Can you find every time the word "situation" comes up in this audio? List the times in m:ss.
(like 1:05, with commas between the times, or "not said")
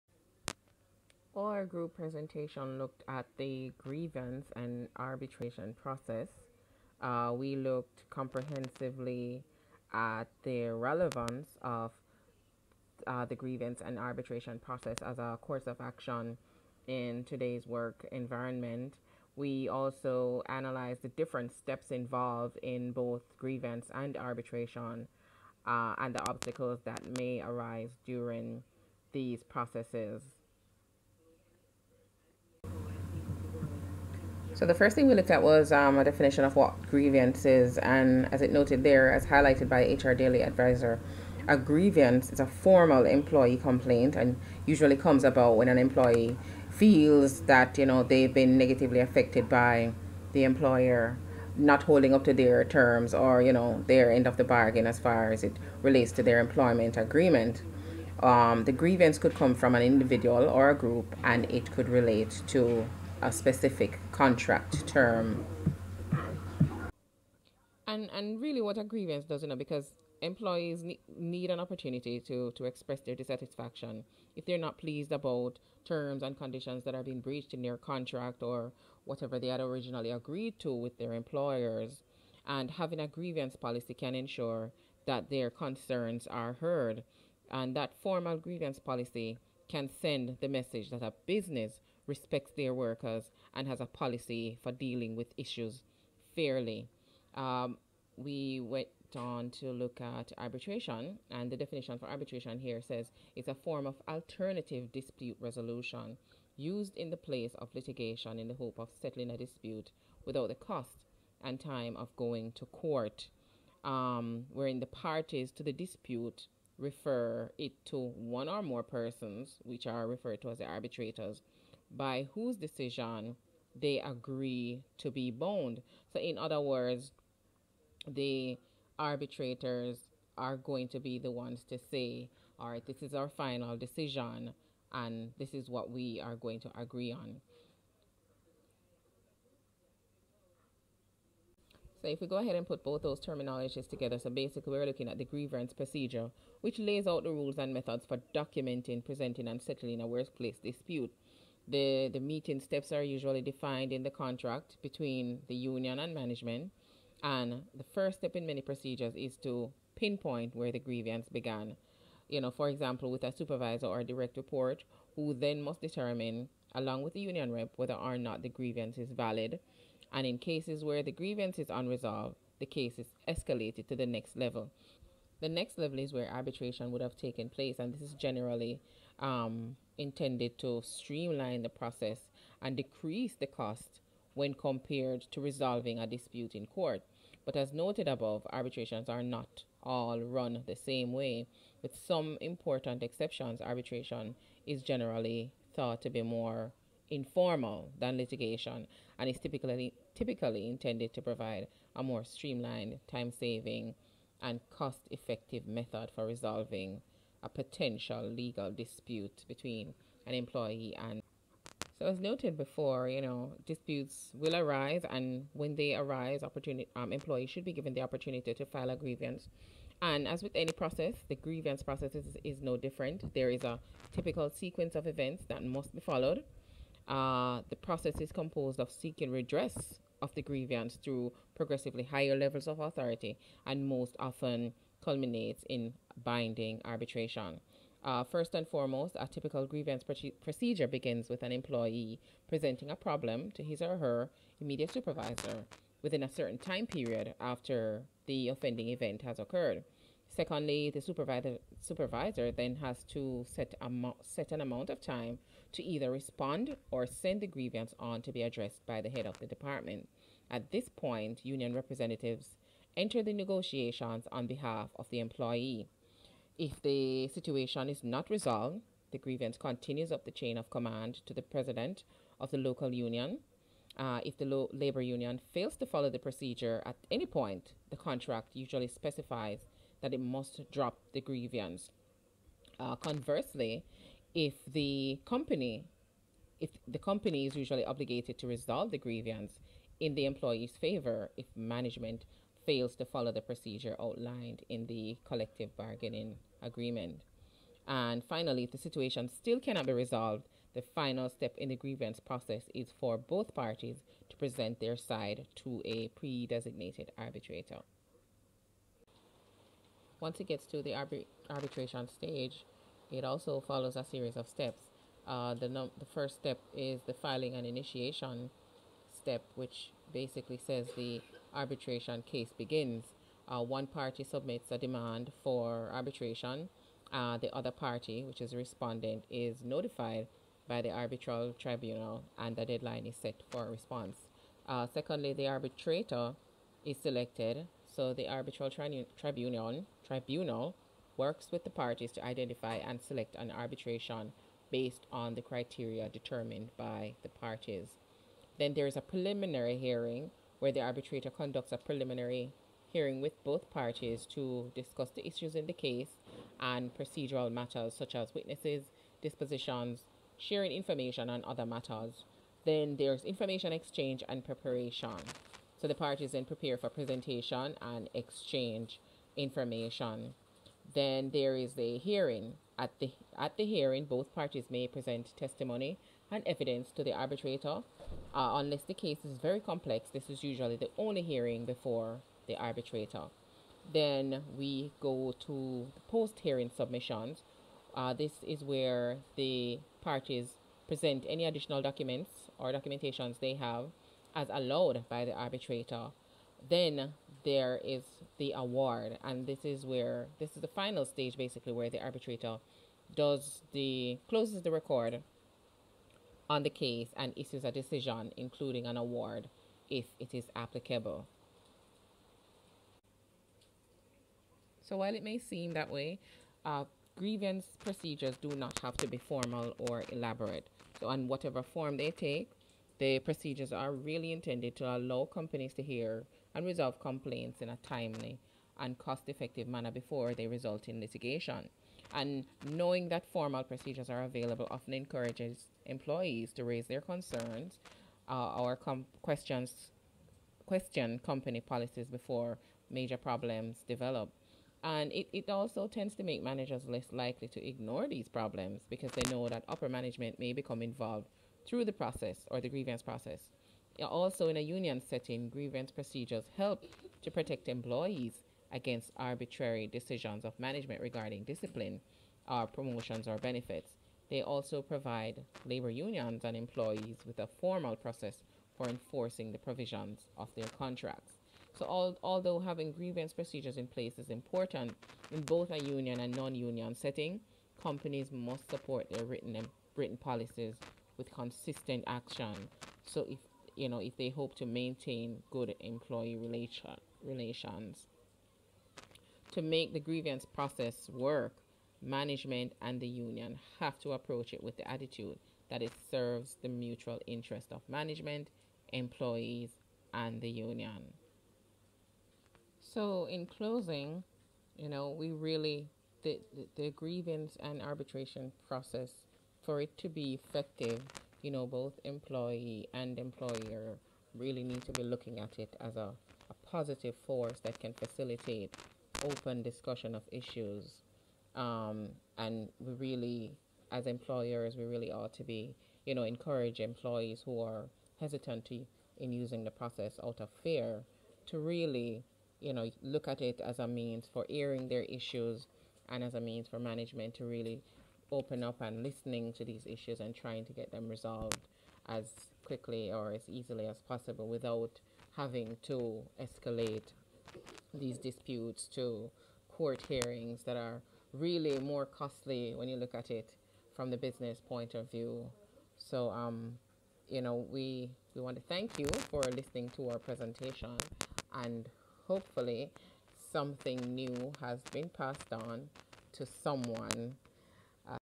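4:27, 4:58.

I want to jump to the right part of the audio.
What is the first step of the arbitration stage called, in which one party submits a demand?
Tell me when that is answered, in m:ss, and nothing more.
5:17.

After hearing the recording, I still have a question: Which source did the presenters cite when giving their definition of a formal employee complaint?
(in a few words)
HR Daily Advisor.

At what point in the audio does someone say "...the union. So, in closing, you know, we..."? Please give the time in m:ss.
8:20.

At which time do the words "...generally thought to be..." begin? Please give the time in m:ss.
3:14.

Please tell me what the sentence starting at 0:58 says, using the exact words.
Um, the grievance could come from an individual or a group, and it could relate to a specific contract term.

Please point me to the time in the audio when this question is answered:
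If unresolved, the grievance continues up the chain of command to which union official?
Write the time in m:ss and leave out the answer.
4:31.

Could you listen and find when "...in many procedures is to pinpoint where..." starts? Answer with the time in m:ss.
2:38.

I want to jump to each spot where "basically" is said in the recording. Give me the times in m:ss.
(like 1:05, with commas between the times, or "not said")
2:24, 5:20, 6:41.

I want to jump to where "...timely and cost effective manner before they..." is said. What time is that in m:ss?
7:07.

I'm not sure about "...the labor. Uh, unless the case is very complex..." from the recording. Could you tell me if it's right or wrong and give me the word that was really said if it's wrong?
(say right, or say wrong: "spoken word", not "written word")
wrong: "arbitrator", not "labor".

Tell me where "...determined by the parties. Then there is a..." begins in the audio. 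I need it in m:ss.
5:46.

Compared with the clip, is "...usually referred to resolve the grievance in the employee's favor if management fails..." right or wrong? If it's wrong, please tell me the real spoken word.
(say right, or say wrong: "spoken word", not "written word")
wrong: "obligated", not "referred".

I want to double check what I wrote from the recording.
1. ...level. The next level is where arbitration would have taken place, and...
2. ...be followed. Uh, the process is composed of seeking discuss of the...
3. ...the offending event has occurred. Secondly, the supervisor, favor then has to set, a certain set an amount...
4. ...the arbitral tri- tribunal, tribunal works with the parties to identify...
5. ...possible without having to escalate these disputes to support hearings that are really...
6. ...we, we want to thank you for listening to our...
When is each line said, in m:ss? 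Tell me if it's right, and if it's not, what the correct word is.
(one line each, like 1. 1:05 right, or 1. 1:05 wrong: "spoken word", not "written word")
1. 2:54 right
2. 3:45 wrong: "redress", not "discuss"
3. 4:08 wrong: "supervisor", not "favor"
4. 5:38 right
5. 9:04 wrong: "court", not "support"
6. 9:17 right.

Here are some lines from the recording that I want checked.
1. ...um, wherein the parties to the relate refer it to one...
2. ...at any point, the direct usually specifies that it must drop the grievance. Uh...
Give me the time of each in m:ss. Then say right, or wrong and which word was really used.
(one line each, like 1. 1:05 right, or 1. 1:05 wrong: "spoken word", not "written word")
1. 1:53 wrong: "dispute", not "relate"
2. 4:36 wrong: "contract", not "direct".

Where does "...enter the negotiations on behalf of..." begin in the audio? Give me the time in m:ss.
4:22.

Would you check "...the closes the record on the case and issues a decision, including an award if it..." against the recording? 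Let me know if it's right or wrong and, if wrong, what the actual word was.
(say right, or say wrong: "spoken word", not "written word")
right.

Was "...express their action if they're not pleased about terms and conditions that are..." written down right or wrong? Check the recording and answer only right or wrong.
wrong.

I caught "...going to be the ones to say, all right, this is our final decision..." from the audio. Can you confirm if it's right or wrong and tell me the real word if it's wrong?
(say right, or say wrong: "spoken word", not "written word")
right.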